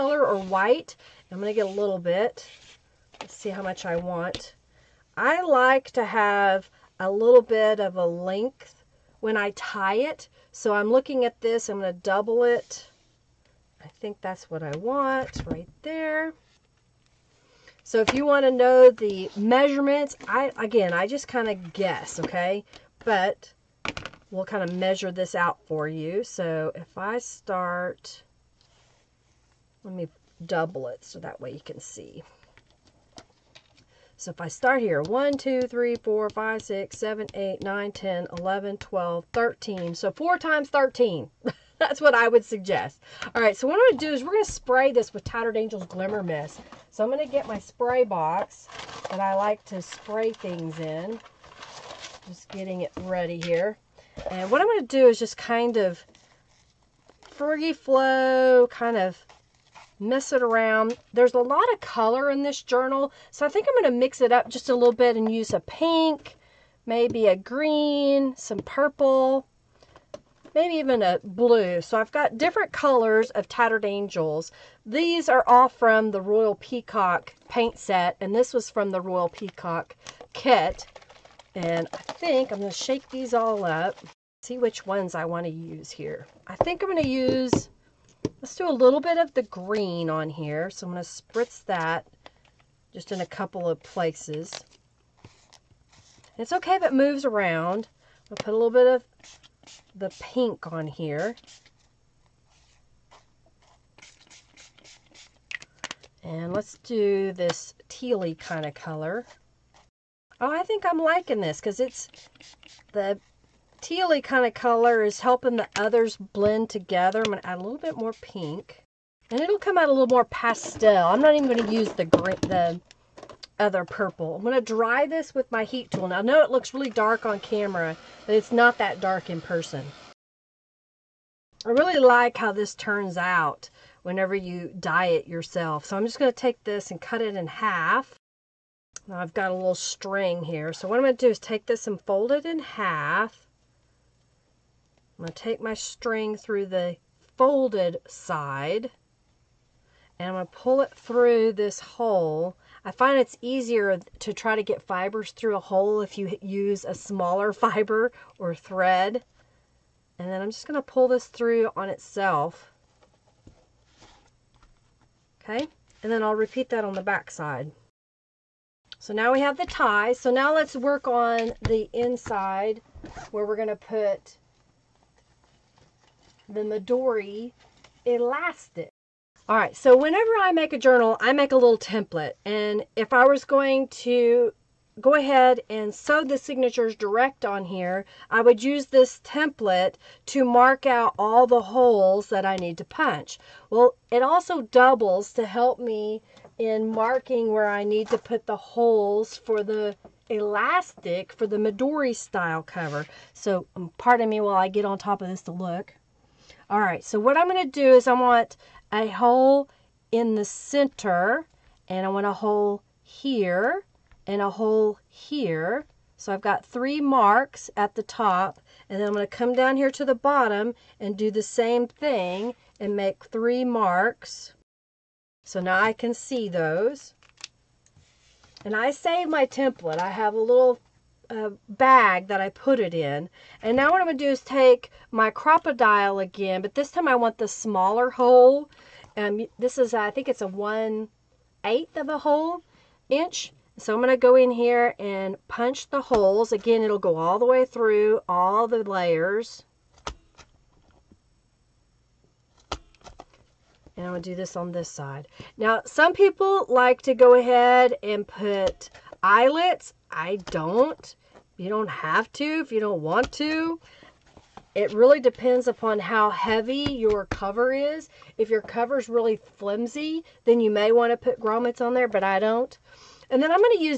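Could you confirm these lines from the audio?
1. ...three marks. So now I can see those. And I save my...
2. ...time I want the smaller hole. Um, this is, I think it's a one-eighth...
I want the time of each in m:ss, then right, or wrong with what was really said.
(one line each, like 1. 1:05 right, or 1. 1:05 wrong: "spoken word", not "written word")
1. 3:43 right
2. 3:56 right.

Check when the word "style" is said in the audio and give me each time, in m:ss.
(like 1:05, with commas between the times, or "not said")
3:22.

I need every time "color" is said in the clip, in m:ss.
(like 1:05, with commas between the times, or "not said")
1:01, 1:12, 1:48, 1:54.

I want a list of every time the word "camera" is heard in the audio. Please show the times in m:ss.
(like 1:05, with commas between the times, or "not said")
2:07.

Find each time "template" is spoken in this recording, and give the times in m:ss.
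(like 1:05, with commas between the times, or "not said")
3:01, 3:09, 3:49.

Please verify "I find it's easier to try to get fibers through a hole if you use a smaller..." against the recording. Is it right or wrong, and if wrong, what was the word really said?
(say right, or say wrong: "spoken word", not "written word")
right.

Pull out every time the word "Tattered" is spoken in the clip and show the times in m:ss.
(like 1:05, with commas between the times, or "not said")
0:45, 1:13.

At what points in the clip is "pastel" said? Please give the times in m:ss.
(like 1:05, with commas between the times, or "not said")
2:00.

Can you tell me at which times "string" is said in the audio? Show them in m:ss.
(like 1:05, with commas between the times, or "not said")
2:19, 2:25.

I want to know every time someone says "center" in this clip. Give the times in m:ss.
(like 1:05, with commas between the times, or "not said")
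3:30.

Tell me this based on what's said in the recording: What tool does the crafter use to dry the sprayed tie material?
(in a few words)
heat tool.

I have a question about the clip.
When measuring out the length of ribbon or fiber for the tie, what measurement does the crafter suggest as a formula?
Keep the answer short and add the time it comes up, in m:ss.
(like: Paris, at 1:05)
4 times 13, at 0:40.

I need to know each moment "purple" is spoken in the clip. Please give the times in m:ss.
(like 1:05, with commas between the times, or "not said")
1:08, 2:03.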